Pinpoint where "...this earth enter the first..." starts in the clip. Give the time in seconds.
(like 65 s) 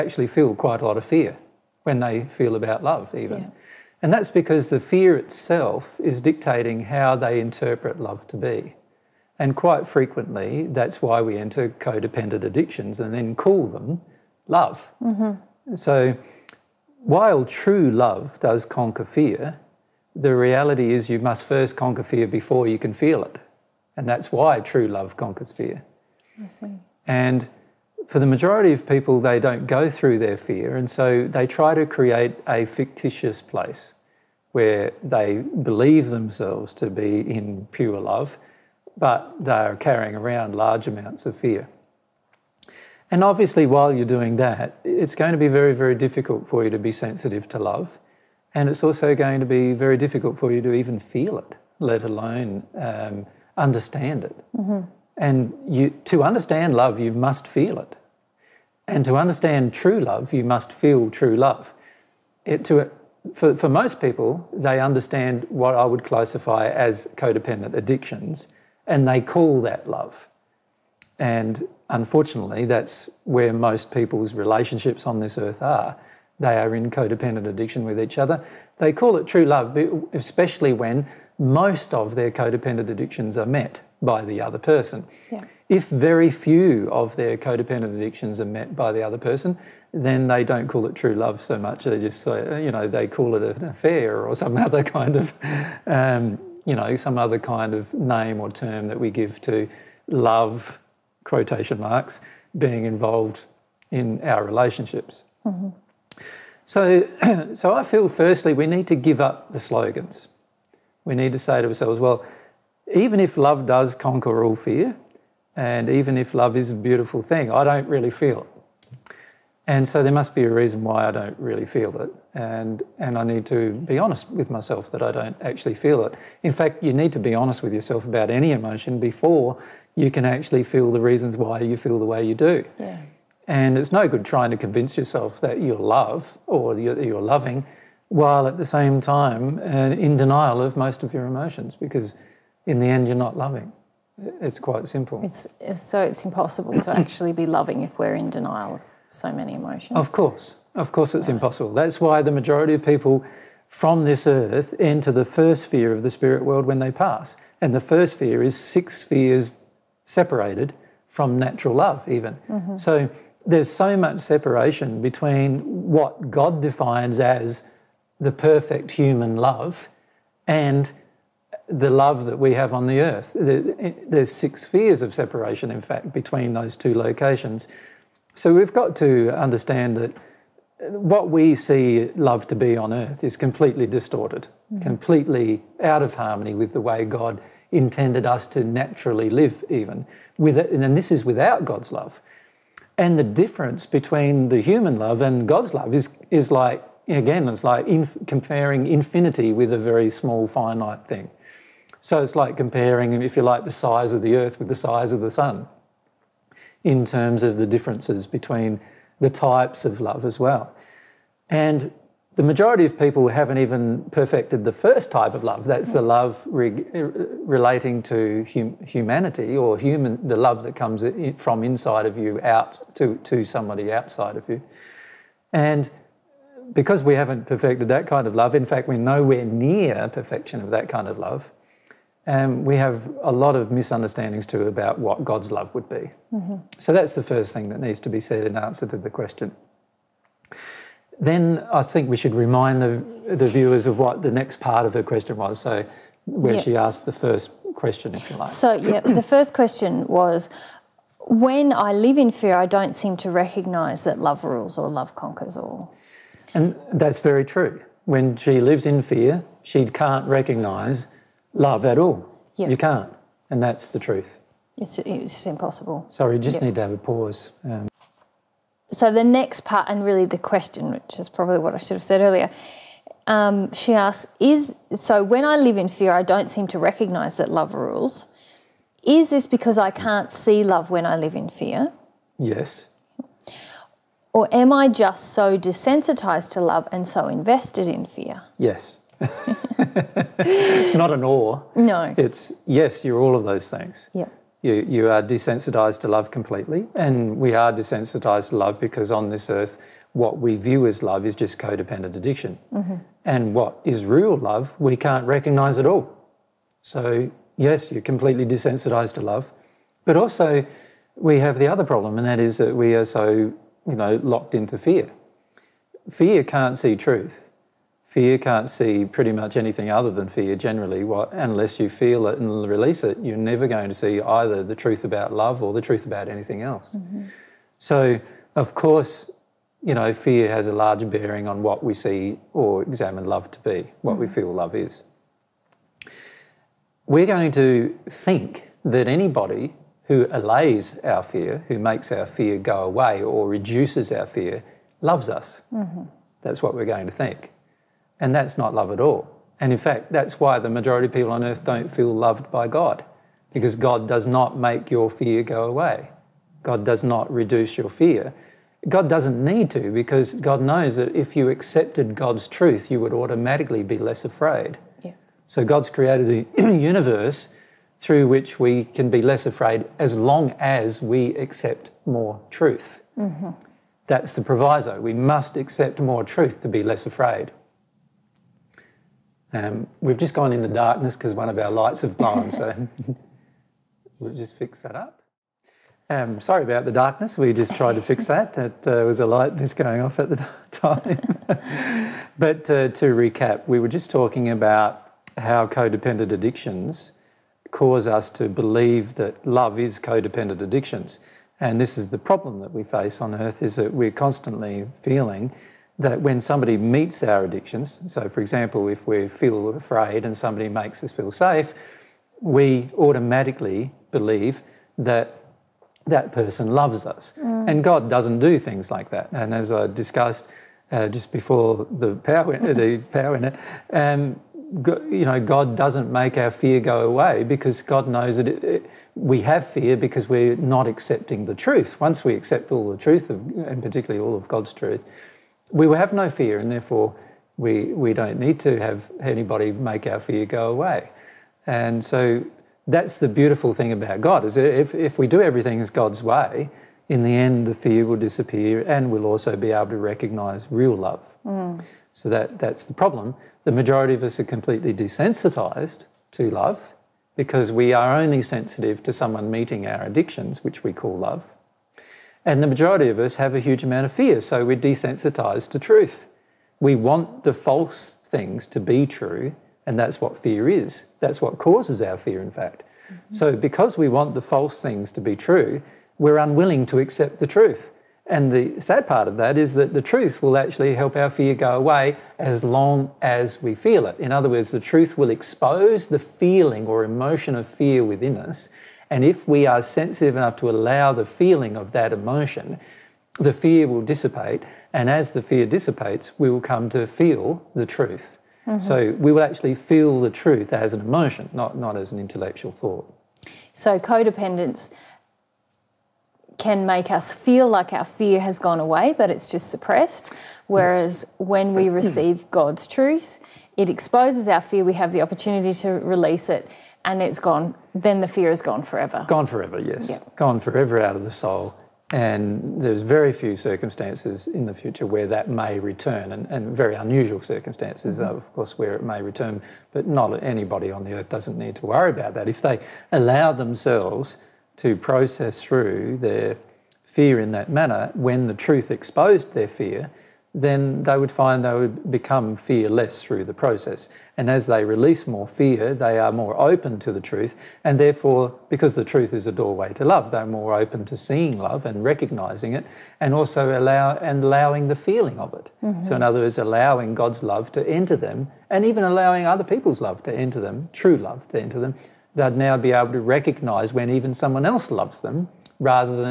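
154 s.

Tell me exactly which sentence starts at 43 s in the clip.
And obviously, while you're doing that, it's going to be very, very difficult for you to be sensitive to love.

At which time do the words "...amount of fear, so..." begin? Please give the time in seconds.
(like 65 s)
463 s.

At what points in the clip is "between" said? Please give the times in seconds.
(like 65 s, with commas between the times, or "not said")
165 s, 176 s, 193 s, 208 s.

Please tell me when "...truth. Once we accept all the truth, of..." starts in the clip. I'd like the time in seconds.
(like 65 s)
431 s.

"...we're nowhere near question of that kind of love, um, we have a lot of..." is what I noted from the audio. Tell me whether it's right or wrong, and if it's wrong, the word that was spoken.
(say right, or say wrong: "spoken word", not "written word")
wrong: "perfection", not "question".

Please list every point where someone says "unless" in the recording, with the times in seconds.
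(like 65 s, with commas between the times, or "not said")
321 s.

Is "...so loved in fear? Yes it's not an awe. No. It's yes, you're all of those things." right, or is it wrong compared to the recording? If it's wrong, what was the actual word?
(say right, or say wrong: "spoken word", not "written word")
wrong: "invested", not "loved".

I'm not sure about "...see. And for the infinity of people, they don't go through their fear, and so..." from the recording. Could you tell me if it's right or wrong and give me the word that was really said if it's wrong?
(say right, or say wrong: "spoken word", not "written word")
wrong: "majority", not "infinity".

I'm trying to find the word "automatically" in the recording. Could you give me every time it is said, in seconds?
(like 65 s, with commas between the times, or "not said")
363 s, 412 s.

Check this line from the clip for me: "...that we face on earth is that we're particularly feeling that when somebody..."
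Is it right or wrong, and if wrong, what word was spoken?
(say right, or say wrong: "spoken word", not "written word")
wrong: "constantly", not "particularly".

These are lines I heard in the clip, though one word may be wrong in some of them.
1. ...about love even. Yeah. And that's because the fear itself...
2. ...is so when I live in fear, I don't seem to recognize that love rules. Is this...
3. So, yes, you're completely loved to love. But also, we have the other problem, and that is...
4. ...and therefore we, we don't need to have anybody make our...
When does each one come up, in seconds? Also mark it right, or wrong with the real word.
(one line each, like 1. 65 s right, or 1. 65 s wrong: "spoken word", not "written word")
1. 2 s right
2. 274 s right
3. 306 s wrong: "desensitized", not "loved"
4. 436 s right.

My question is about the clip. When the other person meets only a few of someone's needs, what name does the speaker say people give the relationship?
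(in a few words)
An affair.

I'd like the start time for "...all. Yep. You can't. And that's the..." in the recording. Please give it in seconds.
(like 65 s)
261 s.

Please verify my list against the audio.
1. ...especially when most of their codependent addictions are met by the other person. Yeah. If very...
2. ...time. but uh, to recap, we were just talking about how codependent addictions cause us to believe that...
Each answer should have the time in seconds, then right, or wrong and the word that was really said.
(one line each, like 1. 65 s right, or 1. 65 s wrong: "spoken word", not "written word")
1. 80 s right
2. 390 s right.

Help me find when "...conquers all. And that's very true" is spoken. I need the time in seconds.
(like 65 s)
255 s.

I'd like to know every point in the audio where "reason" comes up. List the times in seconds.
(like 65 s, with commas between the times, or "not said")
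120 s, 130 s.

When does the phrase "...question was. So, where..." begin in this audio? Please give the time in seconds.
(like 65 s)
245 s.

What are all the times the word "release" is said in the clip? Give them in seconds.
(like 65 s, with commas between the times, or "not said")
322 s, 515 s, 544 s.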